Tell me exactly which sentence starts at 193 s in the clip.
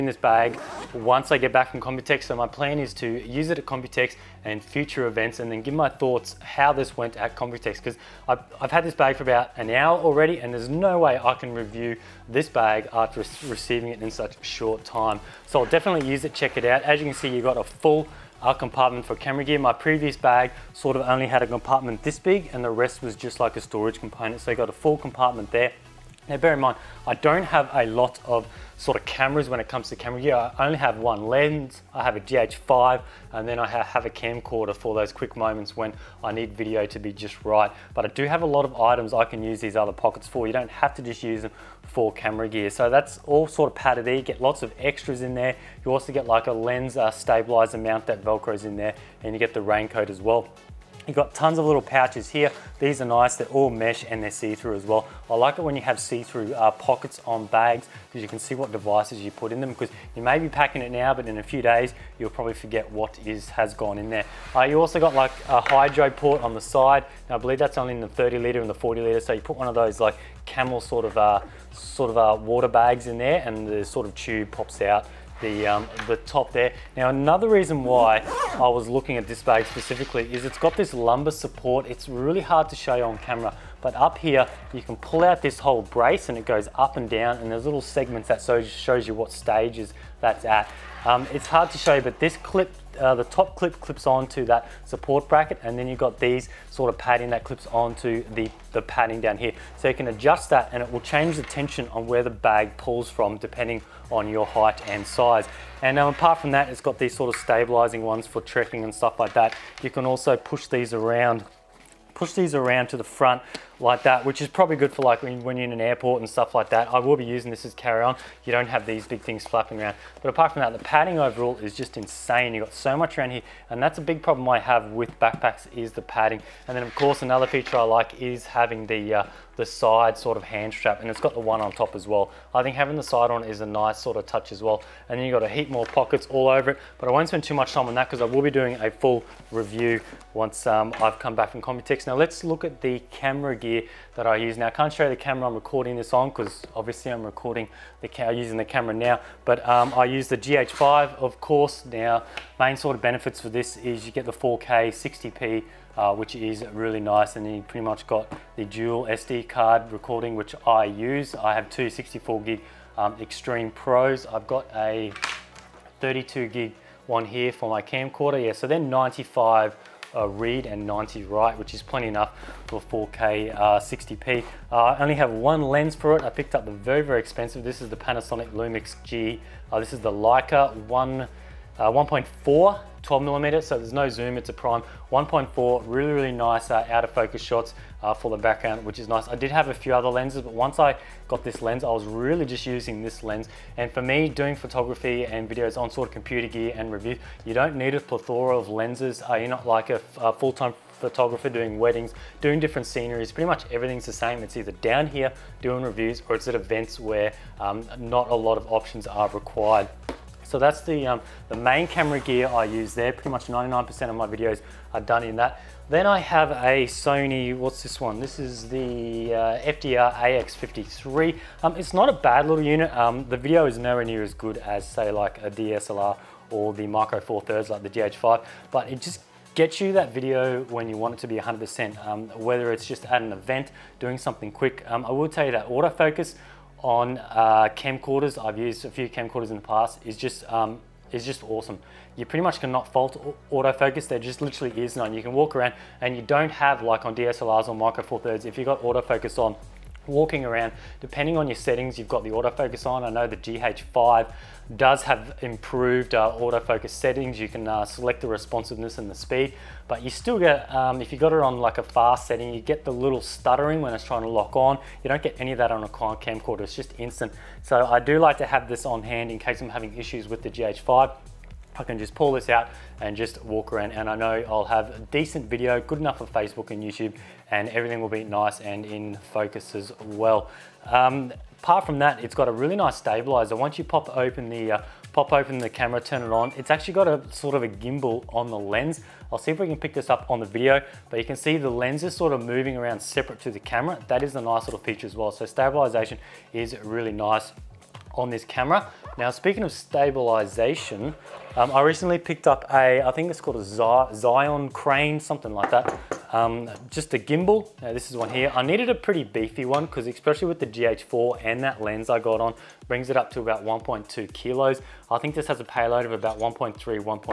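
And for me, doing photography and videos on sort of computer gear and review, you don't need a plethora of lenses.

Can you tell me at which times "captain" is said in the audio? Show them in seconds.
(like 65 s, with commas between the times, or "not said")
not said.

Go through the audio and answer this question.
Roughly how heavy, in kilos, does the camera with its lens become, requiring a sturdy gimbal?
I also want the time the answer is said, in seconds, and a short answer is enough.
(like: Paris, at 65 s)
1.2 kilos, at 313 s.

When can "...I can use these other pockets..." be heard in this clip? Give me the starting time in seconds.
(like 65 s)
39 s.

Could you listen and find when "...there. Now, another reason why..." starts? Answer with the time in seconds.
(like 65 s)
76 s.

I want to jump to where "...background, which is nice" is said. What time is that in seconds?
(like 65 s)
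188 s.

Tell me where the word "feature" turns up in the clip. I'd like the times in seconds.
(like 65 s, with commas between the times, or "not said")
127 s, 294 s.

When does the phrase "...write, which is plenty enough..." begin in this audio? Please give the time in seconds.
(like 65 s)
171 s.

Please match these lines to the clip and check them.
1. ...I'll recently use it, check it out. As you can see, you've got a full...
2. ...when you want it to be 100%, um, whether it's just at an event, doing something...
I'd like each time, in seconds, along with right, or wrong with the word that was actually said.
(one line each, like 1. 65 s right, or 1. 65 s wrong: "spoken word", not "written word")
1. 15 s wrong: "definitely", not "recently"
2. 230 s right.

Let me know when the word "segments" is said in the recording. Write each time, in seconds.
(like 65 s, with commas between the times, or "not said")
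87 s.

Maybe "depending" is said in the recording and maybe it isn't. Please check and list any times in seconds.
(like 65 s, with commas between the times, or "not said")
103 s, 250 s.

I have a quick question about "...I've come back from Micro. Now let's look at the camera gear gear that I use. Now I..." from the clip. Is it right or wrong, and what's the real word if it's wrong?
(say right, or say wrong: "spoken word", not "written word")
wrong: "Computex", not "Micro".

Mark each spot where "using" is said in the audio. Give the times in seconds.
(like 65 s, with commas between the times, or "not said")
117 s, 148 s, 192 s.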